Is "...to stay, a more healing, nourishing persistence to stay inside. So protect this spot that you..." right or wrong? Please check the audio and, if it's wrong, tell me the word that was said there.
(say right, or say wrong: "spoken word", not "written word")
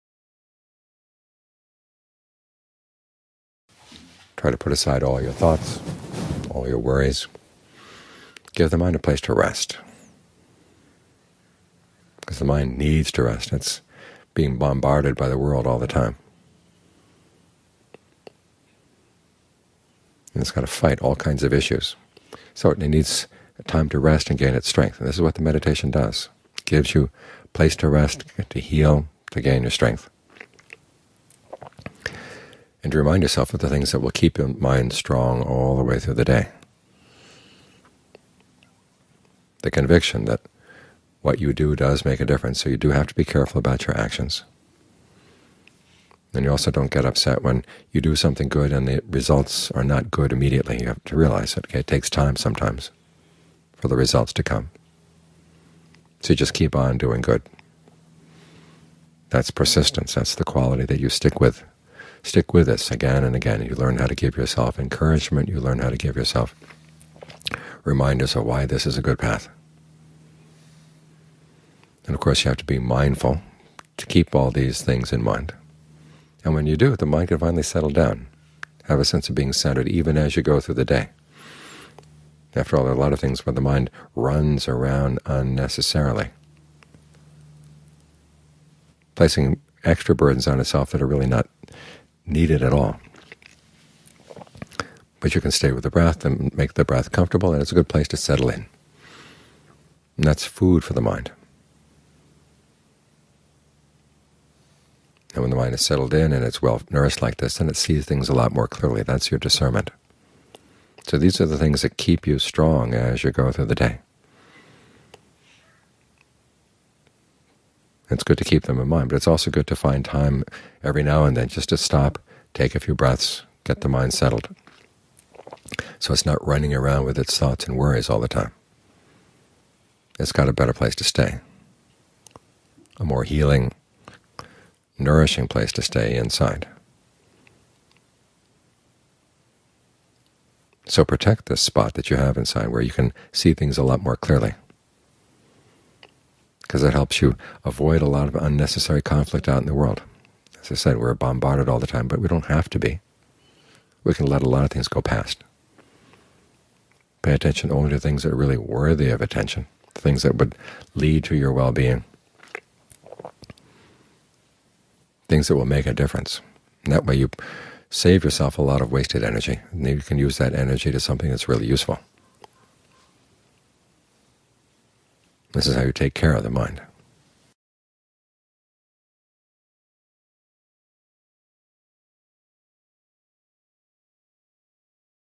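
wrong: "place", not "persistence".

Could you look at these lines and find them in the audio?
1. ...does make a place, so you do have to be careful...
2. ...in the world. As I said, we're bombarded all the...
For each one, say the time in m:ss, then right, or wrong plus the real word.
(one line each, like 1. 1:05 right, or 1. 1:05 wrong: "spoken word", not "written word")
1. 0:41 wrong: "difference", not "place"
2. 2:29 right.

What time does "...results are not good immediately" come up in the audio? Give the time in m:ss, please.
0:49.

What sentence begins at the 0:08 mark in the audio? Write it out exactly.
Give the mind a place to rest.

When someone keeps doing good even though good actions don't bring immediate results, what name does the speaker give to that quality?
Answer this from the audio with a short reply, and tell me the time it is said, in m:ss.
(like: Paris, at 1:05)
Persistence, at 0:59.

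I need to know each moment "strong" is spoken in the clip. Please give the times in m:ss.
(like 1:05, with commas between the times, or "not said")
0:34, 1:52.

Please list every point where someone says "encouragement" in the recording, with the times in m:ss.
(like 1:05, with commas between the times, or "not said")
1:04.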